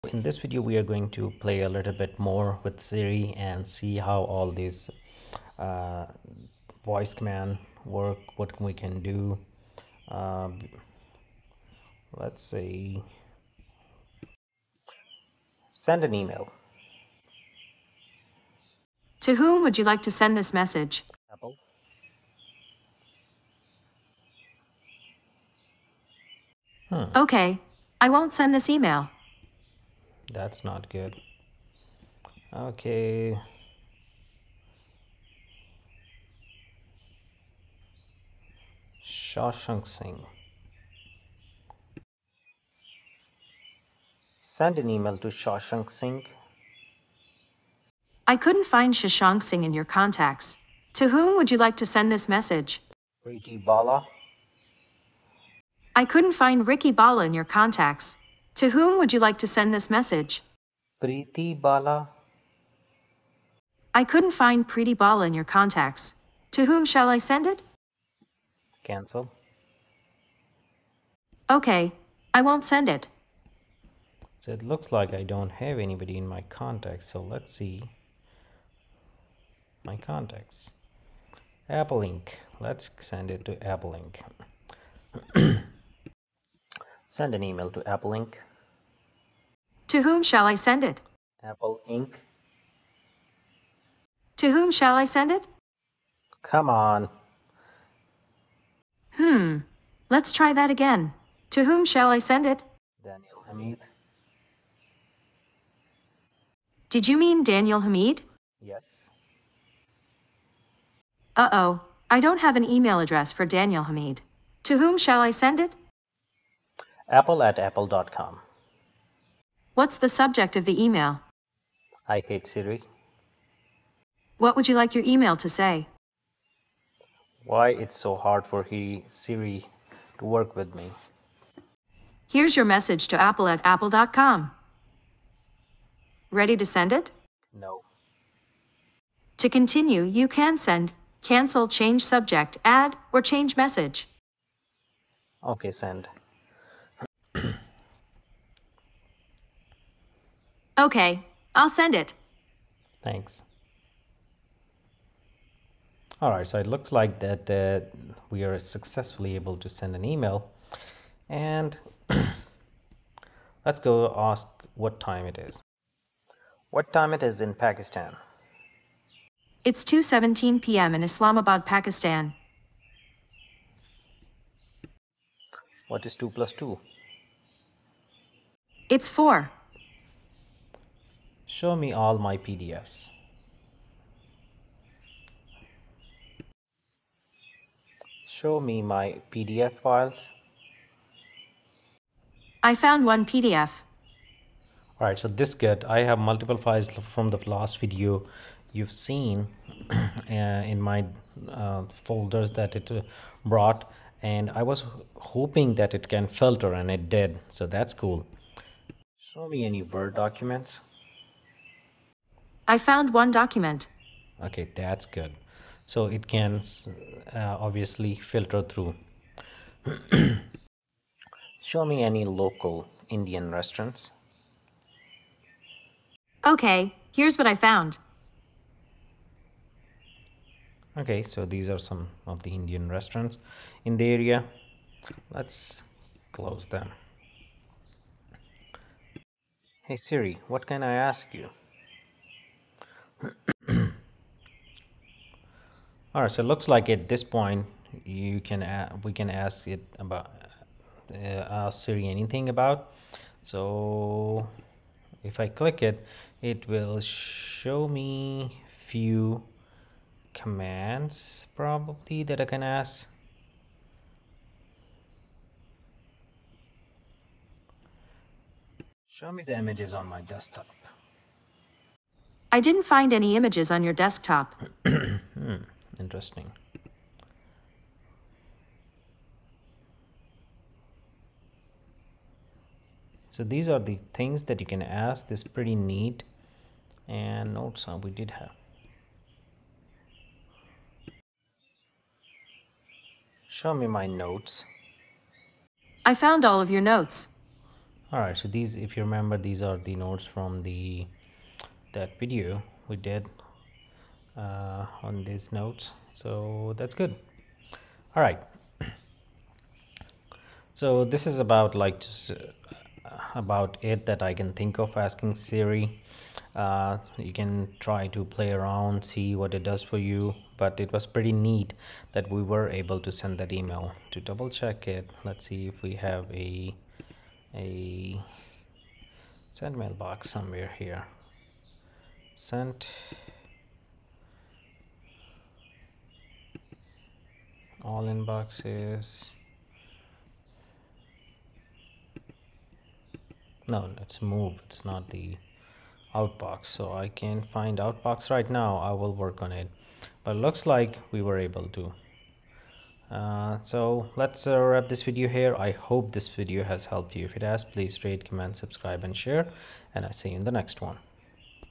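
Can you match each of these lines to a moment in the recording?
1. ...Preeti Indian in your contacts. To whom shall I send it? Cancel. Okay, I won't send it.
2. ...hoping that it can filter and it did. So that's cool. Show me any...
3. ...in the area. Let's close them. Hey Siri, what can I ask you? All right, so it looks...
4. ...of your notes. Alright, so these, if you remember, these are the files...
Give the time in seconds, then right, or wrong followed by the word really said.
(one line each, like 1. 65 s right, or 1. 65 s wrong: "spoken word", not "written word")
1. 64 s wrong: "Bala", not "Indian"
2. 205 s right
3. 233 s right
4. 296 s wrong: "notes", not "files".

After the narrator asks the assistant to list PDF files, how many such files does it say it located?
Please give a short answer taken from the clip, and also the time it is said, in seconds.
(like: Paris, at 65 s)
1, at 193 s.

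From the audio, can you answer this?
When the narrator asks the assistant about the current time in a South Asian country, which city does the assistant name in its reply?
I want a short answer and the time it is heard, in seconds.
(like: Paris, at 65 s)
Islamabad, at 171 s.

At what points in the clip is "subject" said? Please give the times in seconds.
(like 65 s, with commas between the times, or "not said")
120 s, 142 s.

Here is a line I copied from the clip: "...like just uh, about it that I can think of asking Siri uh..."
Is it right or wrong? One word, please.
right.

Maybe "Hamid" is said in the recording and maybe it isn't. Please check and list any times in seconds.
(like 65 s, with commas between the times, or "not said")
103 s, 107 s, 113 s.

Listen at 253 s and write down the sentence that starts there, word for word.
So if I click it, it will show me few commands probably that I can ask.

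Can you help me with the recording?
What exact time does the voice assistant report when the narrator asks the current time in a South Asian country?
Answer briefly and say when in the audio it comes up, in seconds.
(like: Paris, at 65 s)
2:17 p.m., at 169 s.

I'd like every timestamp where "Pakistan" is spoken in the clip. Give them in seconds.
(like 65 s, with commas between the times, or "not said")
167 s, 171 s.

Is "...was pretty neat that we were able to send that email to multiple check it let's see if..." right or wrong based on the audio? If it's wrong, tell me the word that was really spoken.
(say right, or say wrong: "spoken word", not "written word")
wrong: "double", not "multiple".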